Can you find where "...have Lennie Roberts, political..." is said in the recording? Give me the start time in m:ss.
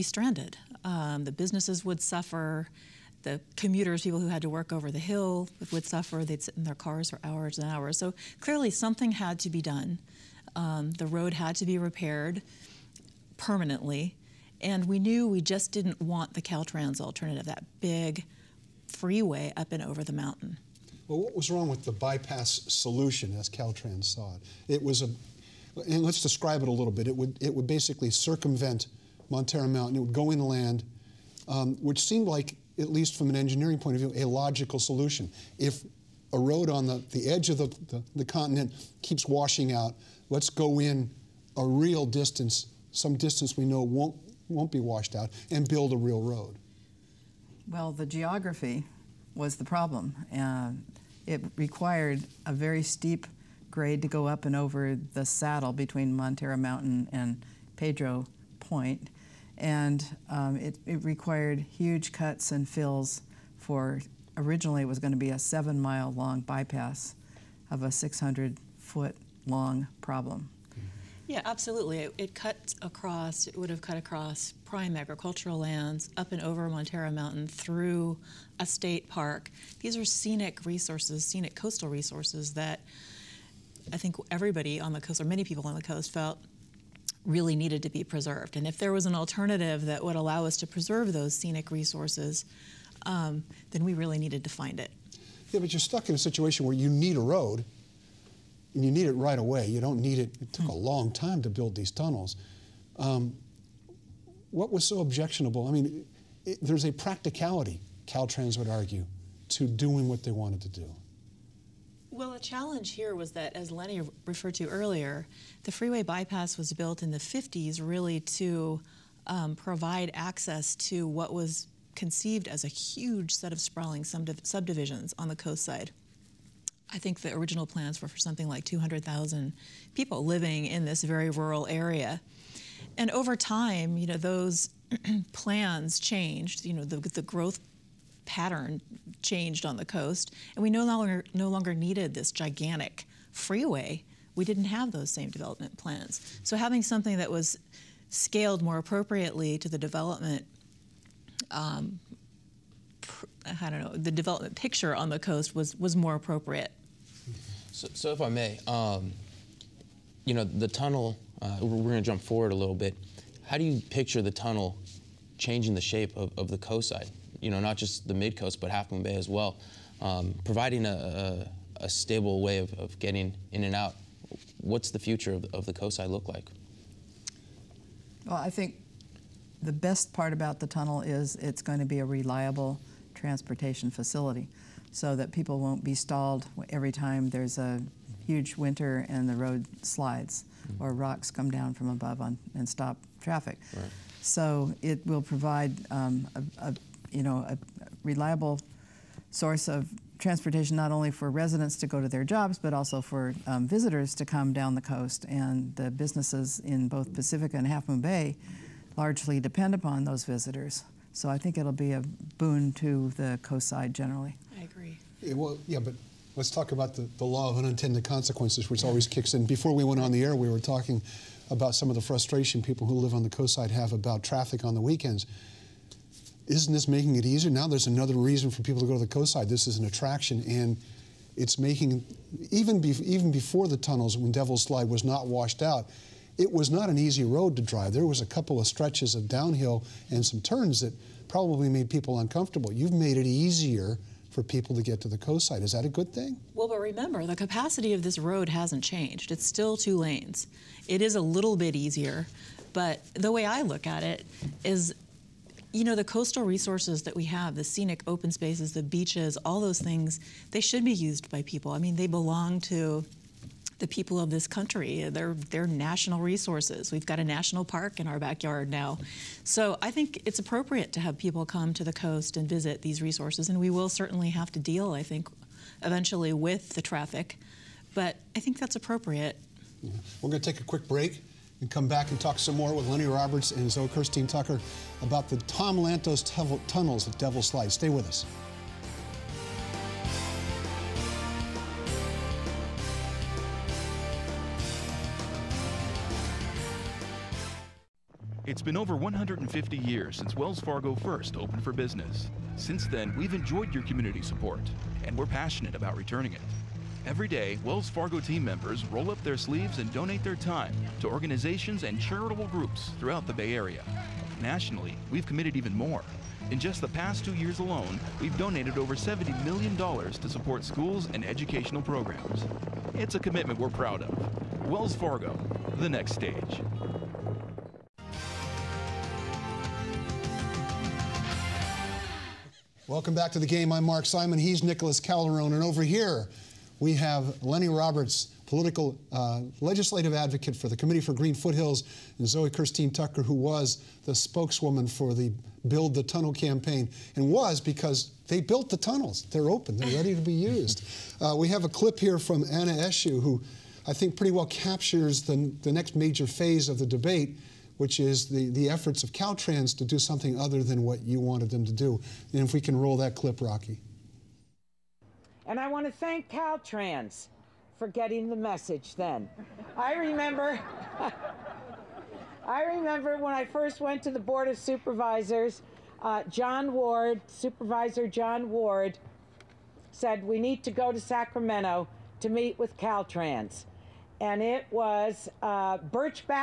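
5:36.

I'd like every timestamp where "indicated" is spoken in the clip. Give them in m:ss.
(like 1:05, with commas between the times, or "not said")
not said.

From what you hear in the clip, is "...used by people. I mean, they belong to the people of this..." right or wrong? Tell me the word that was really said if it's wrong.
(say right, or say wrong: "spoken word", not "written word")
right.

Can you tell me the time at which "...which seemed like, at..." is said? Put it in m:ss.
0:31.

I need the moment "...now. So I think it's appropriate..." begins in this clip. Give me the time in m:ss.
4:28.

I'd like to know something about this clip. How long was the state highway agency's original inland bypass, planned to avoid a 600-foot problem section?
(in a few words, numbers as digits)
7 miles.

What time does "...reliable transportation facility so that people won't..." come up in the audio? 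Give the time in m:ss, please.
3:02.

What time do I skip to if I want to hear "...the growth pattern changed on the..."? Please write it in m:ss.
2:16.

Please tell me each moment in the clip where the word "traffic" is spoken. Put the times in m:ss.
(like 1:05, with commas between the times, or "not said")
3:13, 3:44, 4:36.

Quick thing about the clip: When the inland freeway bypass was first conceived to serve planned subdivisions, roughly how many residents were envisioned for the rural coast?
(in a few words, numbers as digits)
200,000.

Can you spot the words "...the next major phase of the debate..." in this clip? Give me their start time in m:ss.
5:55.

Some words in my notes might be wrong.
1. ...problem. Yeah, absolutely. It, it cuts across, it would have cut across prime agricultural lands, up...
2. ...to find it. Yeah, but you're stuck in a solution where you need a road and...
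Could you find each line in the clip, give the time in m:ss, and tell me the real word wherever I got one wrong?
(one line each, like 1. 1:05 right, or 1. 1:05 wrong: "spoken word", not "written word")
1. 1:10 right
2. 1:34 wrong: "situation", not "solution".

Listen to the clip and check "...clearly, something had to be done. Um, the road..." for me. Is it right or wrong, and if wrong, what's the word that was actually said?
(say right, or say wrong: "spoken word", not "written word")
right.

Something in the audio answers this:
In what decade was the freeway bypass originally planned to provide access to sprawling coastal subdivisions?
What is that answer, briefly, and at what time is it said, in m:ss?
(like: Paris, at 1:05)
the 50s, at 1:57.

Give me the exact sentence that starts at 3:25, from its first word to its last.
And the businesses in both Pacifica and Half Moon Bay largely depend upon those visitors.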